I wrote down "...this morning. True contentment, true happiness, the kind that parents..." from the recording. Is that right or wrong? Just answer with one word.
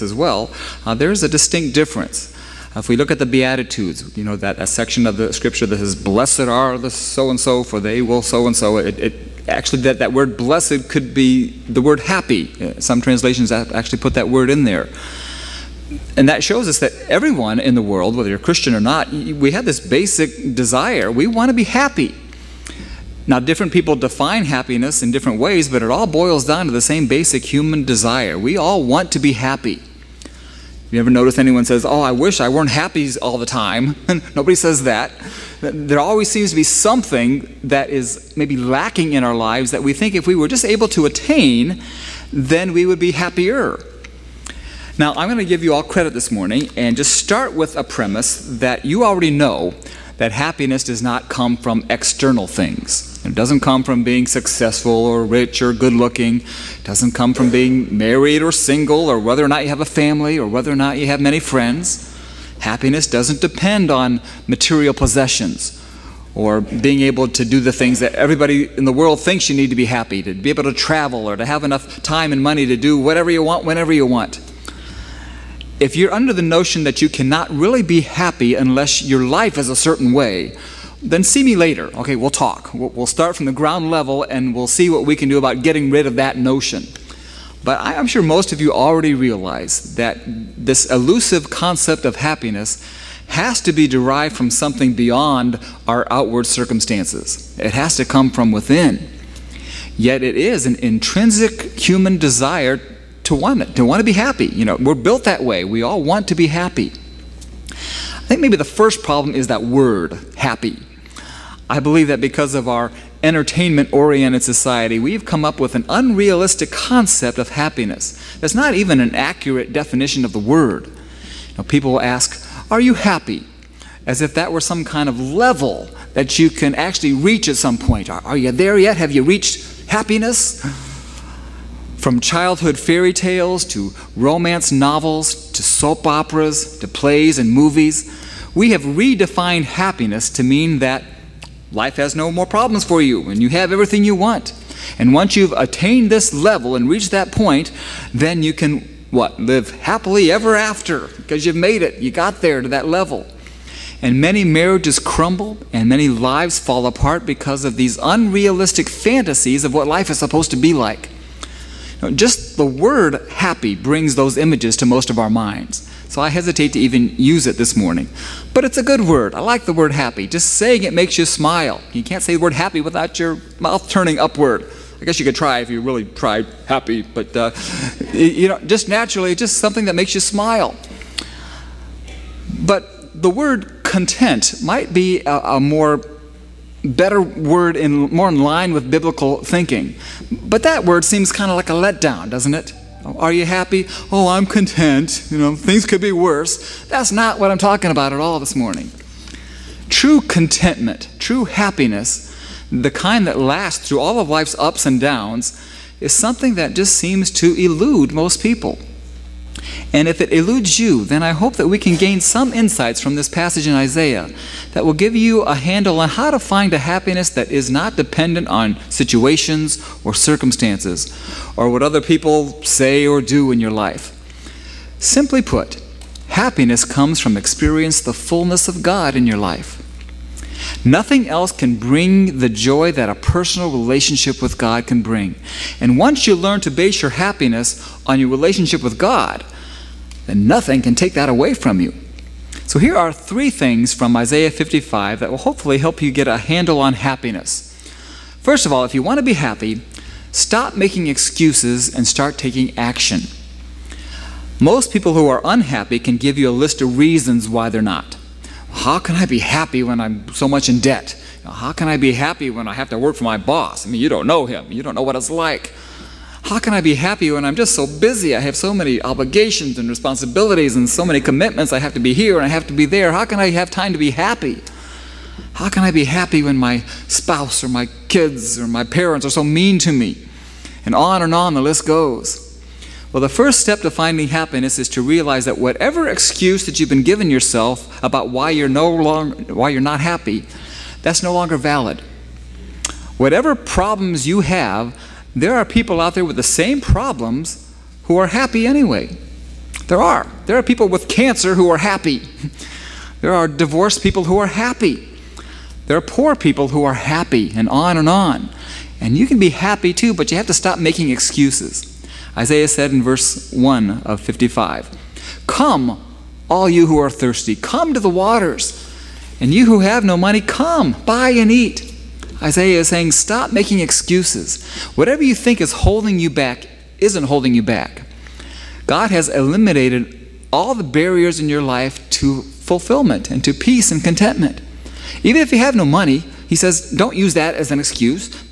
wrong.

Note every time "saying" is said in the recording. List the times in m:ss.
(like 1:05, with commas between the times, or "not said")
2:50, 5:22.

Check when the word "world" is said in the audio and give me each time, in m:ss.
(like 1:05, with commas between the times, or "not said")
0:17, 1:08.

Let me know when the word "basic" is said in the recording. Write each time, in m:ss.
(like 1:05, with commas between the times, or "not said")
0:19, 0:27.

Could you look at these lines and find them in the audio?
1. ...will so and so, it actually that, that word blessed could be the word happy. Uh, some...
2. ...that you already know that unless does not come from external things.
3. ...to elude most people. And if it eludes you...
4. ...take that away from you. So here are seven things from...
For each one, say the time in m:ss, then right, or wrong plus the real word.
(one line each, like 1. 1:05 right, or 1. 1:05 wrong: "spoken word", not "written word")
1. 0:08 right
2. 0:48 wrong: "happiness", not "unless"
3. 3:27 right
4. 4:00 wrong: "three", not "seven".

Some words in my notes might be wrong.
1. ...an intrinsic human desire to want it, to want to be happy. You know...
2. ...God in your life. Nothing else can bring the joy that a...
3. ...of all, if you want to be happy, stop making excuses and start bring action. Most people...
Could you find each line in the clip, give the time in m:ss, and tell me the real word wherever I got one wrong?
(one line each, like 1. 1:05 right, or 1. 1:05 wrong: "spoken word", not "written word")
1. 1:40 right
2. 3:48 right
3. 4:08 wrong: "taking", not "bring".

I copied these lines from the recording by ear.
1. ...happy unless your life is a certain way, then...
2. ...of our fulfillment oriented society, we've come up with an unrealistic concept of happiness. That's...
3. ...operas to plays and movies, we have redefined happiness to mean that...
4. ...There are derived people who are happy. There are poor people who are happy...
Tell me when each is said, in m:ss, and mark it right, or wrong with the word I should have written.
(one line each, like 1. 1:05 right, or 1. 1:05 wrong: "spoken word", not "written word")
1. 1:18 right
2. 1:52 wrong: "entertainment", not "fulfillment"
3. 2:16 right
4. 5:03 wrong: "divorced", not "derived".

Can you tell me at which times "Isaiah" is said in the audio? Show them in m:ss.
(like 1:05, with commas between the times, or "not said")
3:33, 4:04, 5:12, 5:22.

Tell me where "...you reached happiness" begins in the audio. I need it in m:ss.
2:09.